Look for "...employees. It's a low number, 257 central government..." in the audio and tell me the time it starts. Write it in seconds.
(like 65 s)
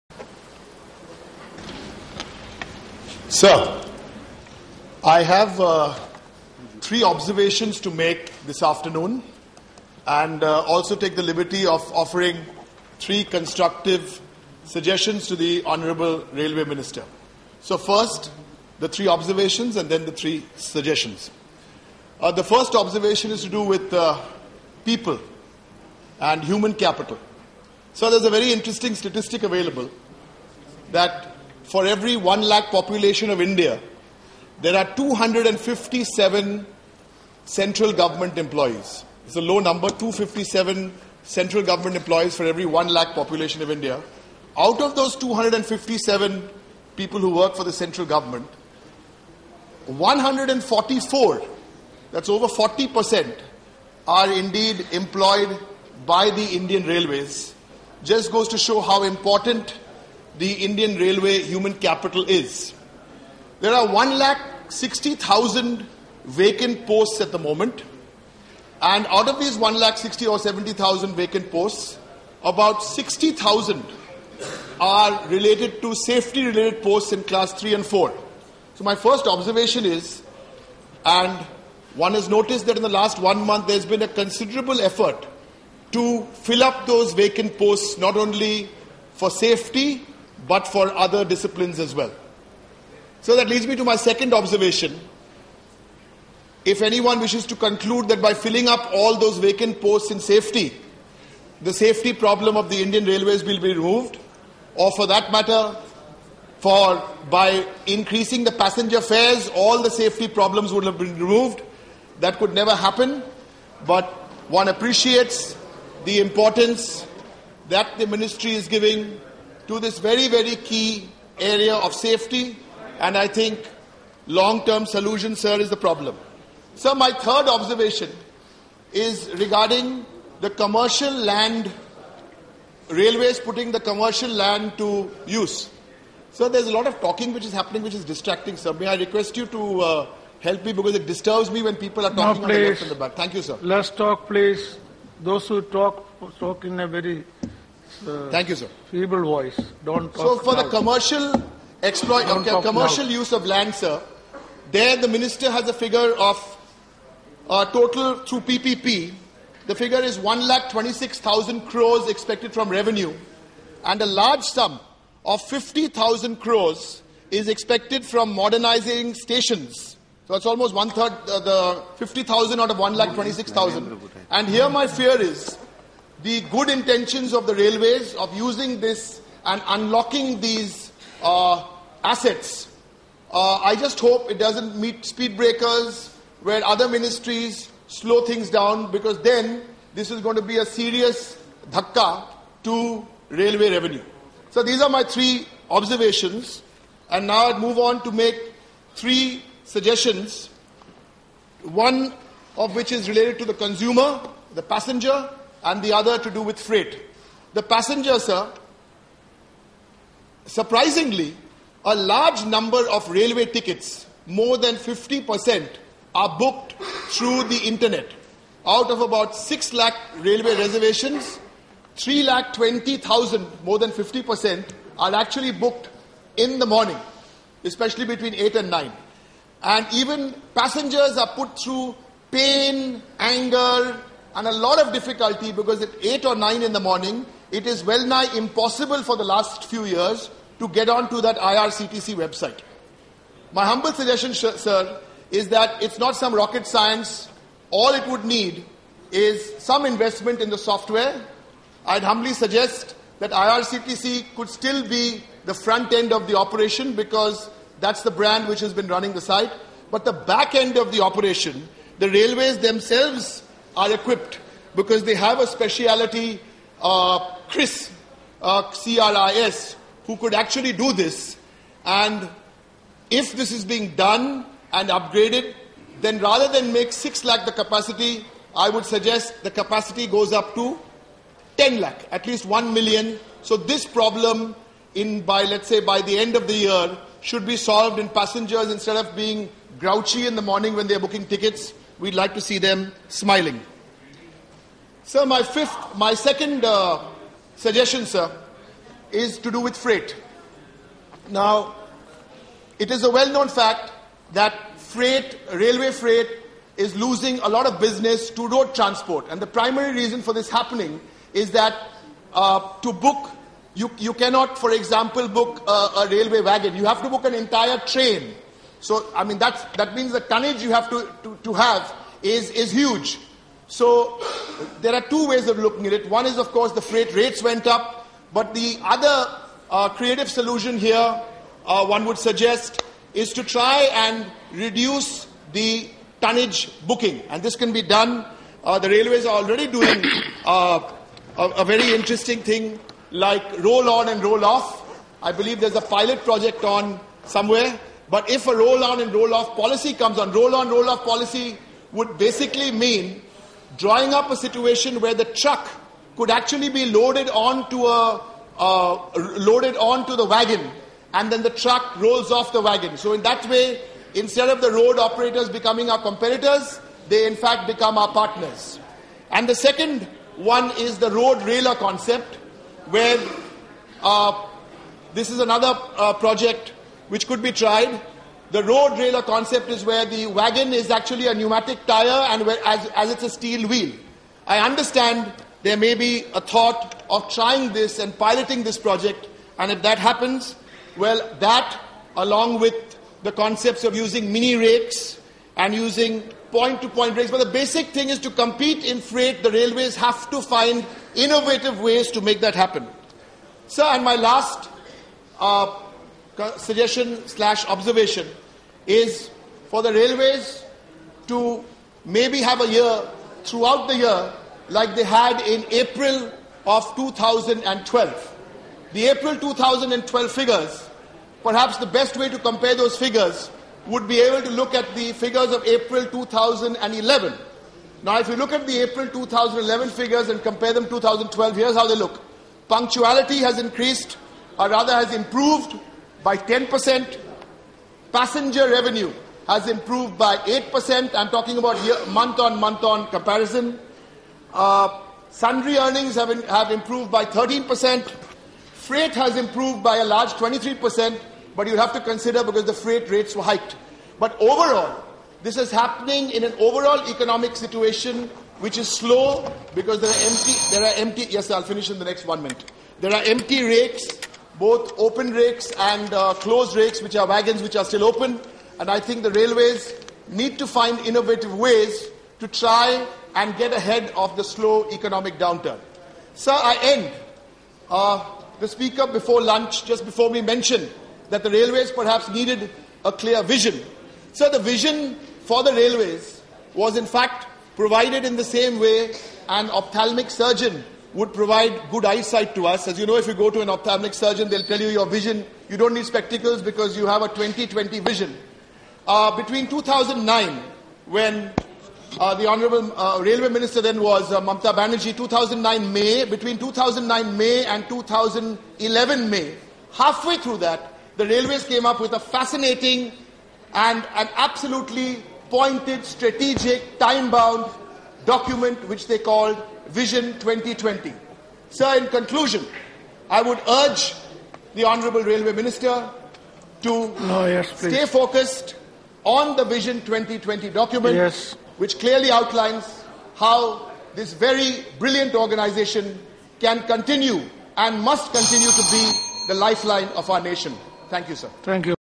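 38 s.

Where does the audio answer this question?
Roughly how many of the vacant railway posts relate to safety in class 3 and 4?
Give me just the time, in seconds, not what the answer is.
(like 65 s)
72 s.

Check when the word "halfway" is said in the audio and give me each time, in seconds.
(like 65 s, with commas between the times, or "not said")
509 s.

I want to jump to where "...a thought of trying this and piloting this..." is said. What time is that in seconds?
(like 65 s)
386 s.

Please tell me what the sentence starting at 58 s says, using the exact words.
Just goes to show how important the Indian Railway human capital is.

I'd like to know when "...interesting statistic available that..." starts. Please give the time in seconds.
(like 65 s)
28 s.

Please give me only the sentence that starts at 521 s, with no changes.
Sir, in conclusion, I would urge the Honourable Railway Minister to no, yes, stay focused on the Vision 2020 document, yes.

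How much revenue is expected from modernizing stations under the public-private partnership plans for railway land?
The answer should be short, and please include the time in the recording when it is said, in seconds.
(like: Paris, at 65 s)
50,000 crores, at 165 s.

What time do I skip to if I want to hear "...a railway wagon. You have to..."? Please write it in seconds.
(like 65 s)
315 s.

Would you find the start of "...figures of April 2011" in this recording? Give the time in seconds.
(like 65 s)
425 s.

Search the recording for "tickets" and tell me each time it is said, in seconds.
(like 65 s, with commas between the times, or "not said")
213 s, 291 s.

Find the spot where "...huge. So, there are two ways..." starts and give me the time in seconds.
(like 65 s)
322 s.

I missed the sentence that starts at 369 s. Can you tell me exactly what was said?
And the second one is the road railer concept, where uh, this is another uh, project which could be tried.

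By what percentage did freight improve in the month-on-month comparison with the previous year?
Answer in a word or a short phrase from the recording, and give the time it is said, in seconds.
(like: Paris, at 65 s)
23%, at 450 s.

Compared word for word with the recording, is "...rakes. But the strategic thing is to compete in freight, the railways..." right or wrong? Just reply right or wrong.
wrong.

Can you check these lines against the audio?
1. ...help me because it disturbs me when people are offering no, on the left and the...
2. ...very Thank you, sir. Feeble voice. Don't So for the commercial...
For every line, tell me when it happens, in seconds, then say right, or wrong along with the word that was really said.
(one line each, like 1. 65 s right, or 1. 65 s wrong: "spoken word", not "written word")
1. 140 s wrong: "talking", not "offering"
2. 146 s right.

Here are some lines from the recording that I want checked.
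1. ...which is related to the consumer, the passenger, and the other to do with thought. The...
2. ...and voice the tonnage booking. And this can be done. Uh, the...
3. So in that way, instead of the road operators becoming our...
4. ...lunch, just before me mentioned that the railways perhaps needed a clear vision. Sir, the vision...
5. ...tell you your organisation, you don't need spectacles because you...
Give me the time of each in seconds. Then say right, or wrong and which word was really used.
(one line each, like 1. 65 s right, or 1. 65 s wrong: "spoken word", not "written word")
1. 202 s wrong: "freight", not "thought"
2. 333 s wrong: "reduce", not "voice"
3. 362 s right
4. 479 s right
5. 494 s wrong: "vision", not "organisation".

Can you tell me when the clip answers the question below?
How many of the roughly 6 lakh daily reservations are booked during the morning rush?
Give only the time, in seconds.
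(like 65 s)
221 s.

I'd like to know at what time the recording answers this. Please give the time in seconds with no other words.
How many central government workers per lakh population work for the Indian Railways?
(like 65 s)
49 s.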